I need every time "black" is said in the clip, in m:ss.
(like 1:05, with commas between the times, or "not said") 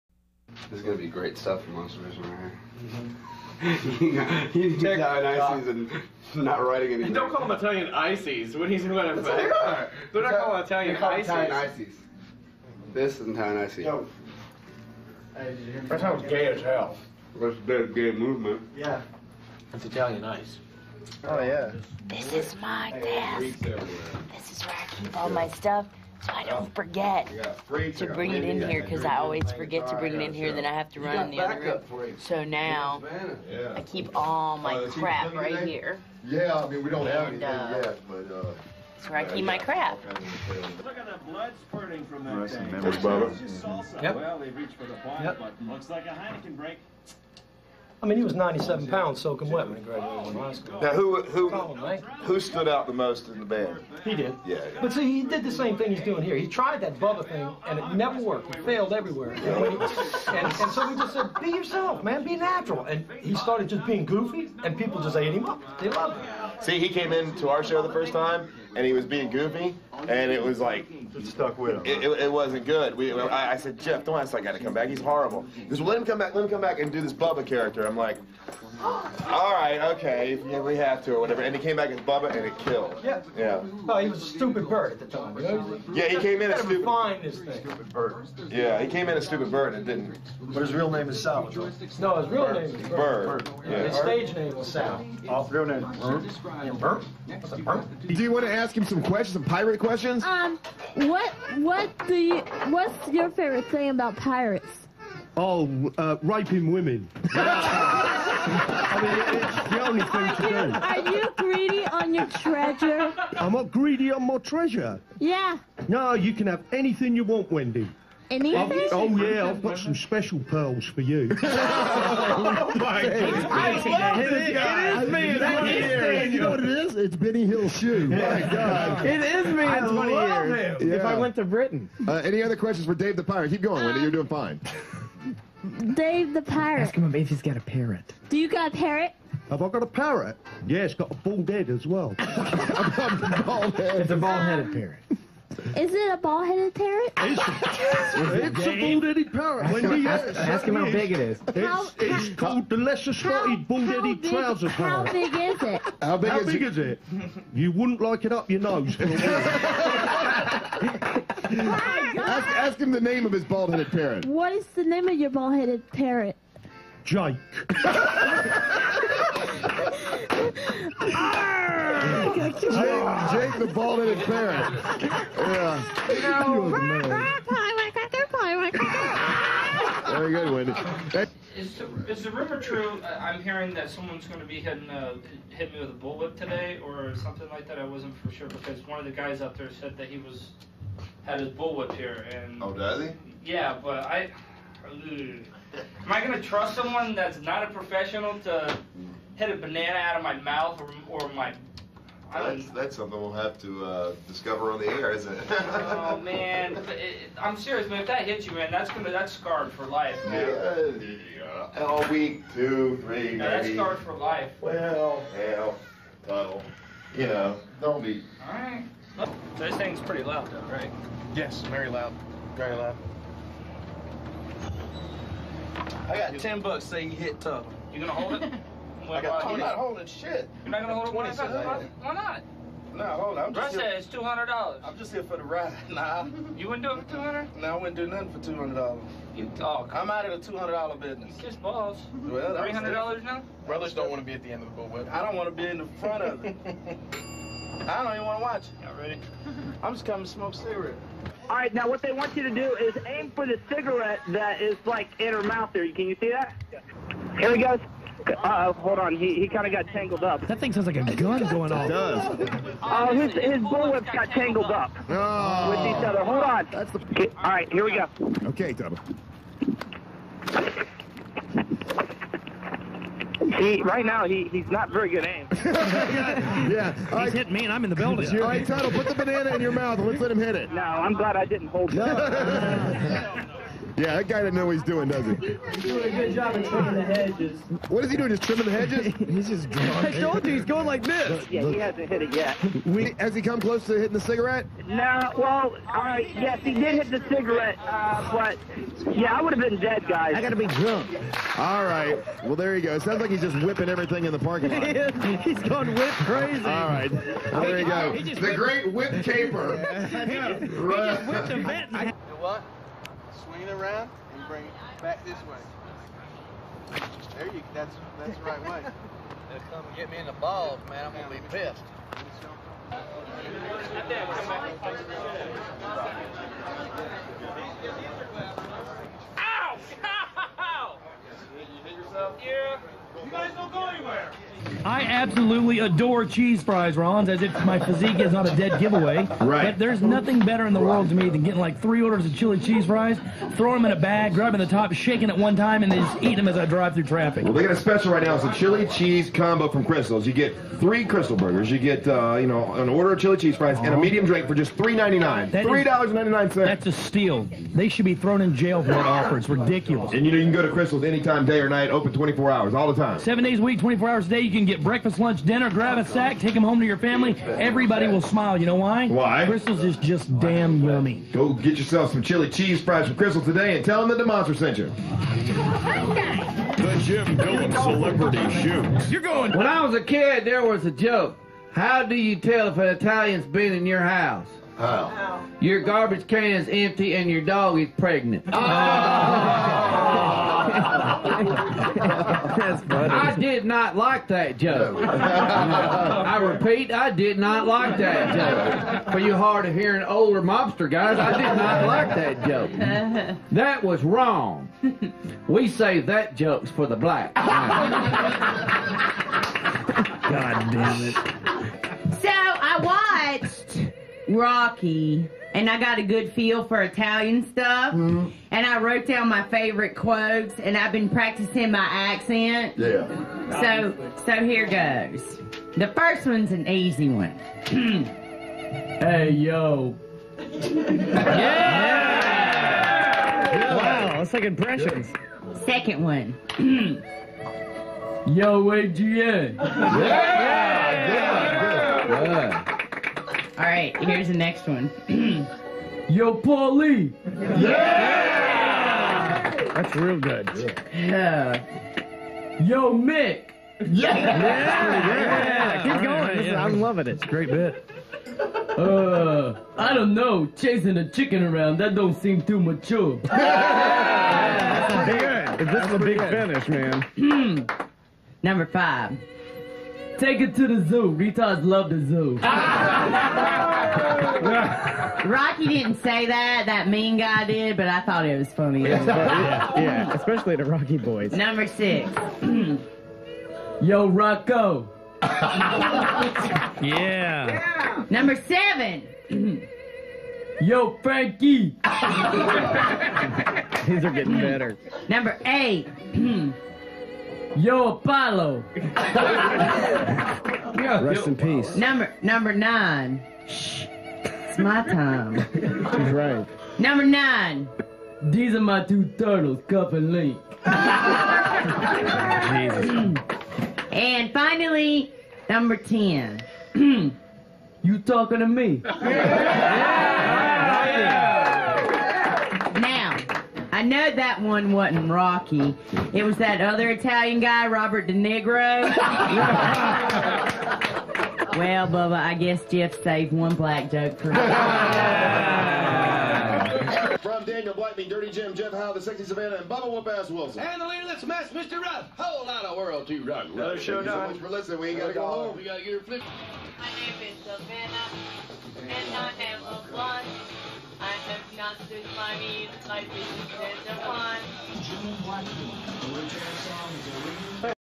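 6:46, 8:53.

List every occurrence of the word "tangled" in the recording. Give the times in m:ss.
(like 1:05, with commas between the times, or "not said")
4:19, 4:24.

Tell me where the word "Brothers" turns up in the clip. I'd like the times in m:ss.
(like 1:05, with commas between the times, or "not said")
4:03.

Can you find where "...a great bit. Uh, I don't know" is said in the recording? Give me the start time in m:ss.
7:37.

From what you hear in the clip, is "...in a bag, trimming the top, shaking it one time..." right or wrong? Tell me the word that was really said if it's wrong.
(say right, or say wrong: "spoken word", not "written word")
wrong: "grabbing", not "trimming".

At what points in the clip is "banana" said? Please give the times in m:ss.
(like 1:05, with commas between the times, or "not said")
3:19, 4:39.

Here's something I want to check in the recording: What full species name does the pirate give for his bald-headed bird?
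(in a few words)
lesser spotted bald headed trouser parrot.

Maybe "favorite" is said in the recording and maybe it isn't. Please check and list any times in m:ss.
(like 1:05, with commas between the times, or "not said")
1:43, 6:59.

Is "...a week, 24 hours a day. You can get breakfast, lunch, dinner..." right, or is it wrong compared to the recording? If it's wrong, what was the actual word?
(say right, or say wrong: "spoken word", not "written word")
right.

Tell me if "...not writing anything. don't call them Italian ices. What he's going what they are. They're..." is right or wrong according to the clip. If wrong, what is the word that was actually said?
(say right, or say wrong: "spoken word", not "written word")
right.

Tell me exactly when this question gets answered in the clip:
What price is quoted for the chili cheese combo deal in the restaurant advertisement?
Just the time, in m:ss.
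5:54.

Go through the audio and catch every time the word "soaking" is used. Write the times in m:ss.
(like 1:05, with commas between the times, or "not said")
0:49.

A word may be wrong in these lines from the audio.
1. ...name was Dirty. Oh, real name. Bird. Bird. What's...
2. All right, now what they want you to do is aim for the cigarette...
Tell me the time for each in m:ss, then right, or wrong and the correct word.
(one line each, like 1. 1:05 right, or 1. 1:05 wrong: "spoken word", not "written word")
1. 1:34 wrong: "Sal", not "Dirty"
2. 4:11 right.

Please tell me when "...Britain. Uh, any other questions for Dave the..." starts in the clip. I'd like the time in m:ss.
2:11.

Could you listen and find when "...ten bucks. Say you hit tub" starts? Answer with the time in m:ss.
3:46.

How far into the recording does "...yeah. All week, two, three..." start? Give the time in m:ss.
3:31.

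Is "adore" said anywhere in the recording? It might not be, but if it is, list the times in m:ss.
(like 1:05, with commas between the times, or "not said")
5:35.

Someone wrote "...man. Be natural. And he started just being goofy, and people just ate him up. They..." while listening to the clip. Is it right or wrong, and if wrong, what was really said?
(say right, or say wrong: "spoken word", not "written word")
right.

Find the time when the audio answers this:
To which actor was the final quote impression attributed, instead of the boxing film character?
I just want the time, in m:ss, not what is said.
8:47.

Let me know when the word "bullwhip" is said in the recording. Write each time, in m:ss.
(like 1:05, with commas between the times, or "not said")
3:05, 3:11, 4:04, 4:23.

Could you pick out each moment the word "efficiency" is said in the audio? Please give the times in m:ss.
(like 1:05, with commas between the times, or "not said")
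not said.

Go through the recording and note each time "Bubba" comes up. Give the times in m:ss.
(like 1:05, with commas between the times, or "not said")
0:56, 1:17, 1:21, 8:51, 8:59.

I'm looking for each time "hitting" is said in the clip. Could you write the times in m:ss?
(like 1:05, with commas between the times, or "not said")
3:04, 4:53.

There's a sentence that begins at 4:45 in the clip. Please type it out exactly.
He's doing a good job of trimming the hedges.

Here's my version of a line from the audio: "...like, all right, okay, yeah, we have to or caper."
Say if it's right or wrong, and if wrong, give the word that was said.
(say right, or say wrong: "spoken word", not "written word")
wrong: "whatever", not "caper".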